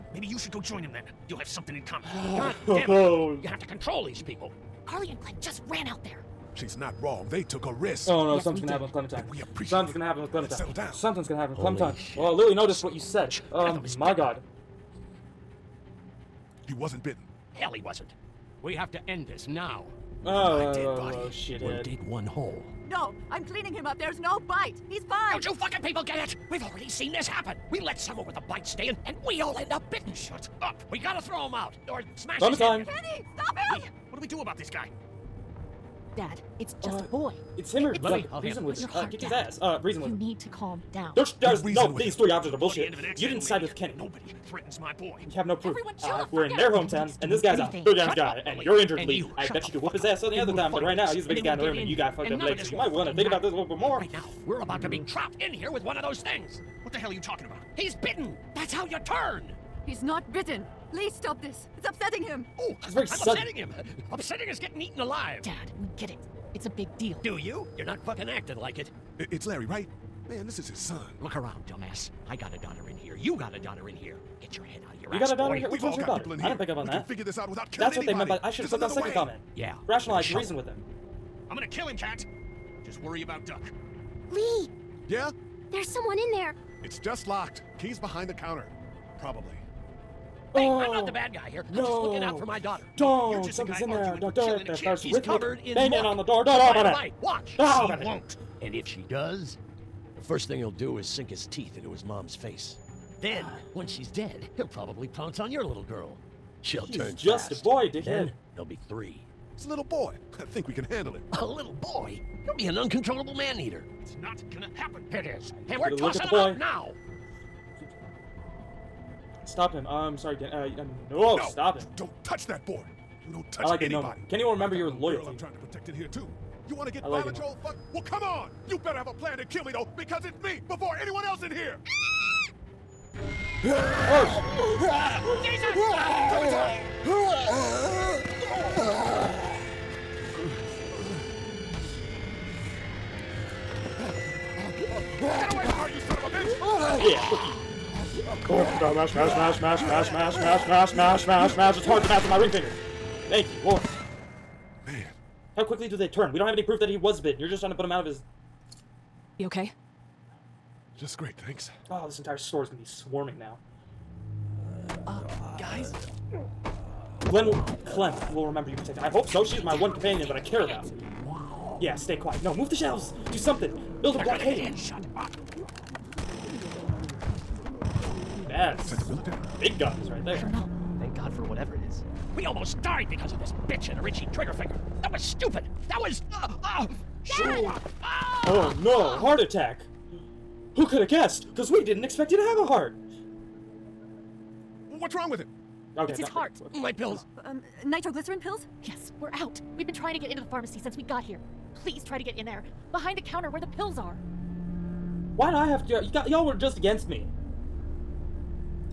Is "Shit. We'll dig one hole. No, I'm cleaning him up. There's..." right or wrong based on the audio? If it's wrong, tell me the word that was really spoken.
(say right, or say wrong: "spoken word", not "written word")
right.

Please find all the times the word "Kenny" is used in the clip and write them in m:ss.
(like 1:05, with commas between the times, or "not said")
0:32, 0:43.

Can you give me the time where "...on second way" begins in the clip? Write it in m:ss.
1:18.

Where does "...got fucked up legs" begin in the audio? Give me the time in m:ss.
0:51.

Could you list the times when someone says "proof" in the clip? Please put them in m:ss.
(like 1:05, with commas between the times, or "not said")
0:45, 2:36.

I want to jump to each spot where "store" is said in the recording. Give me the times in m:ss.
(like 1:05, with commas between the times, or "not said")
2:42.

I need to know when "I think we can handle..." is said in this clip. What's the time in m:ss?
1:50.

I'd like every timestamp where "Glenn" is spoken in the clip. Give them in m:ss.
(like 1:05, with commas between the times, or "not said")
0:05, 2:47.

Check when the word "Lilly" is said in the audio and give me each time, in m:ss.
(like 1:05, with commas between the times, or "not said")
0:12.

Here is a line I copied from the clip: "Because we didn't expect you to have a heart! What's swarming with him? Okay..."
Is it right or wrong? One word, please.
wrong.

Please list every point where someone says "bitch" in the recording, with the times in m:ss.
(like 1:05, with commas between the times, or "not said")
2:26, 3:03.